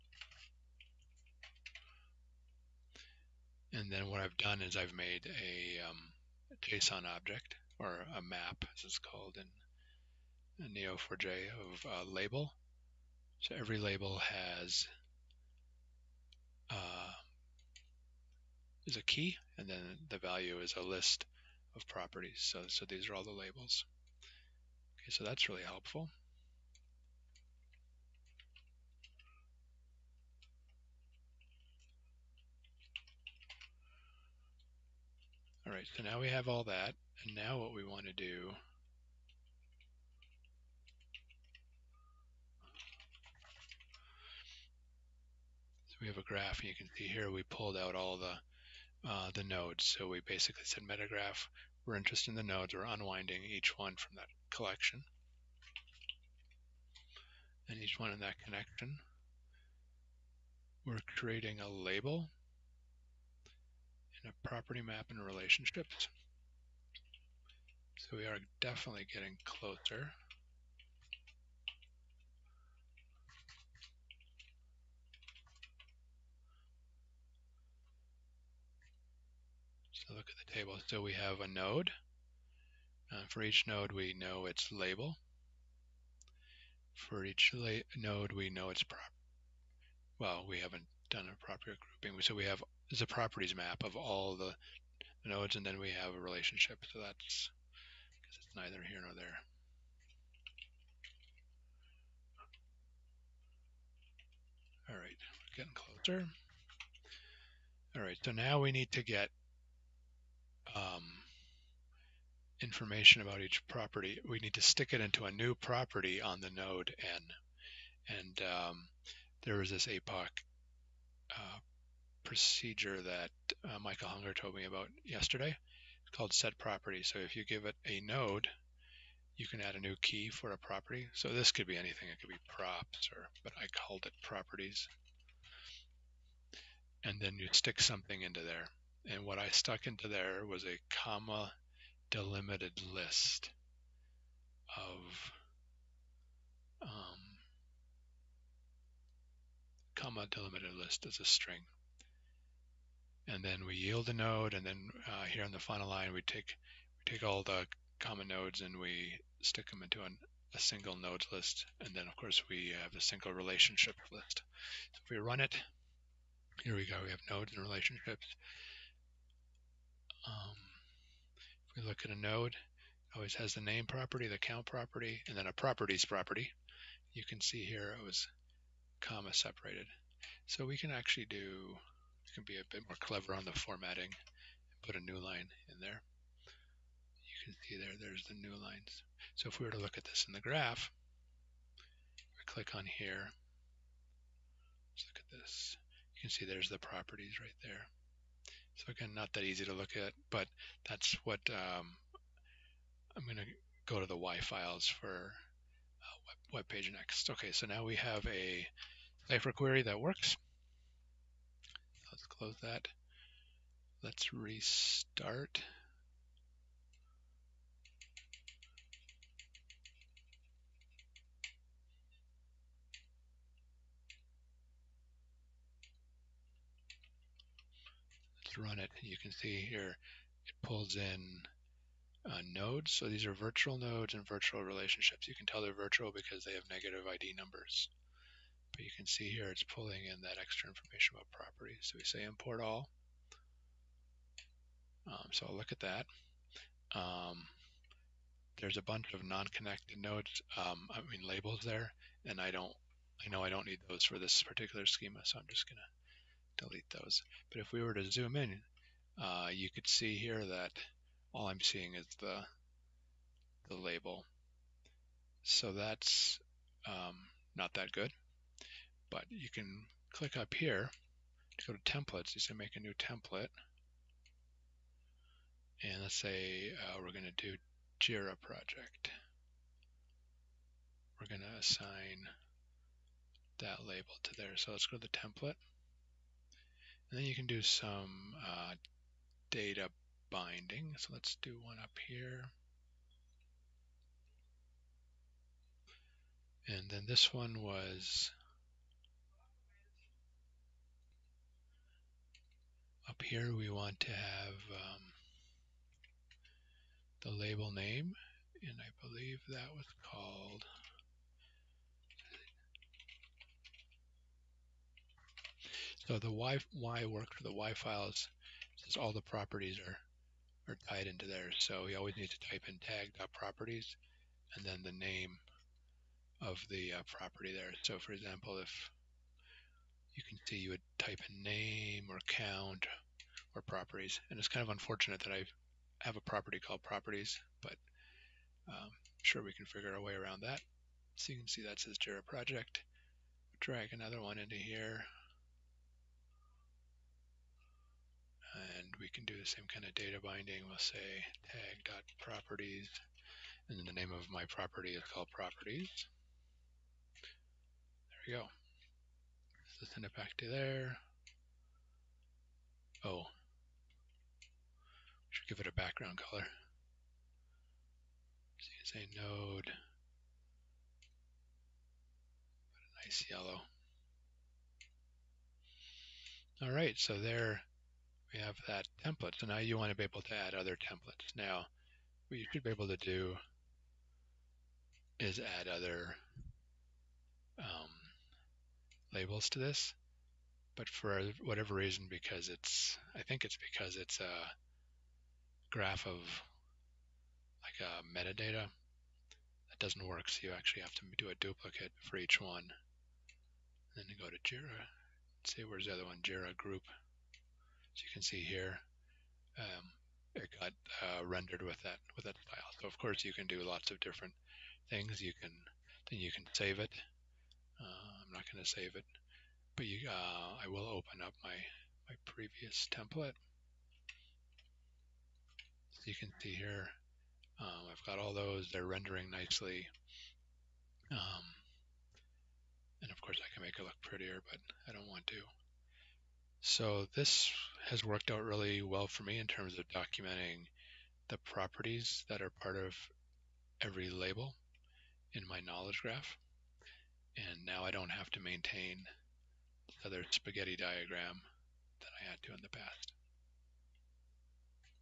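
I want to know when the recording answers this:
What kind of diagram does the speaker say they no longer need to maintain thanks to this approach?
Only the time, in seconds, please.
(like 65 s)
450 s.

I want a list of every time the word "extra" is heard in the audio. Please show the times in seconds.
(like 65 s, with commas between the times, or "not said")
240 s.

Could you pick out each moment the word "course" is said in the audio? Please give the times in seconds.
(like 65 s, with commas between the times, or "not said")
162 s, 412 s, 433 s.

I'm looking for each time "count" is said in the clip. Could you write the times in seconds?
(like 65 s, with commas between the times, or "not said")
174 s, 332 s.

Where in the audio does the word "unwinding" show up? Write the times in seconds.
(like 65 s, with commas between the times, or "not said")
52 s.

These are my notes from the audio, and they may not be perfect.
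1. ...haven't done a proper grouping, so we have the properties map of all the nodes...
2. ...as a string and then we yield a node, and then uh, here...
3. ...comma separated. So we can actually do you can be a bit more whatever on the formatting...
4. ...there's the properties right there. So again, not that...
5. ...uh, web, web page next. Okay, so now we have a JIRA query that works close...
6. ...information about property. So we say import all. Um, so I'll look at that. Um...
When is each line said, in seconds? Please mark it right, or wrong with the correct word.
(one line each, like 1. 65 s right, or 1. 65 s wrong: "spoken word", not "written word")
1. 90 s right
2. 151 s right
3. 178 s wrong: "clever", not "whatever"
4. 196 s right
5. 205 s wrong: "Cypher", not "JIRA"
6. 240 s right.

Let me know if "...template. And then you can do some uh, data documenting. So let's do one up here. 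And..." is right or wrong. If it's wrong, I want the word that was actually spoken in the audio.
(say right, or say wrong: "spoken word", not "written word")
wrong: "binding", not "documenting".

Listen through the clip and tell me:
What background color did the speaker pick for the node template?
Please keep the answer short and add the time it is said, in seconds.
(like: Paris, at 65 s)
yellow, at 373 s.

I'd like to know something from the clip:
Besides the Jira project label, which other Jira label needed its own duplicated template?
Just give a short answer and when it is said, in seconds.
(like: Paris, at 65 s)
Jira group, at 406 s.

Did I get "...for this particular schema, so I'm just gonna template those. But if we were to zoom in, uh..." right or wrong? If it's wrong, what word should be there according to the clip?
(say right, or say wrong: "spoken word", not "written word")
wrong: "delete", not "template".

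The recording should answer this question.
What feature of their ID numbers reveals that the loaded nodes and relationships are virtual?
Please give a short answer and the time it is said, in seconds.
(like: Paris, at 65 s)
negative ID numbers, at 236 s.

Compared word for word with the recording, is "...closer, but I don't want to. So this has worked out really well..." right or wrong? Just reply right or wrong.
wrong.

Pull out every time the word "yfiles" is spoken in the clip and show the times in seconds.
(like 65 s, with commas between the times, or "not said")
204 s, 317 s.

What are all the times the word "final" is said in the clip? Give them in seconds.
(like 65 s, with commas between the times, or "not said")
155 s.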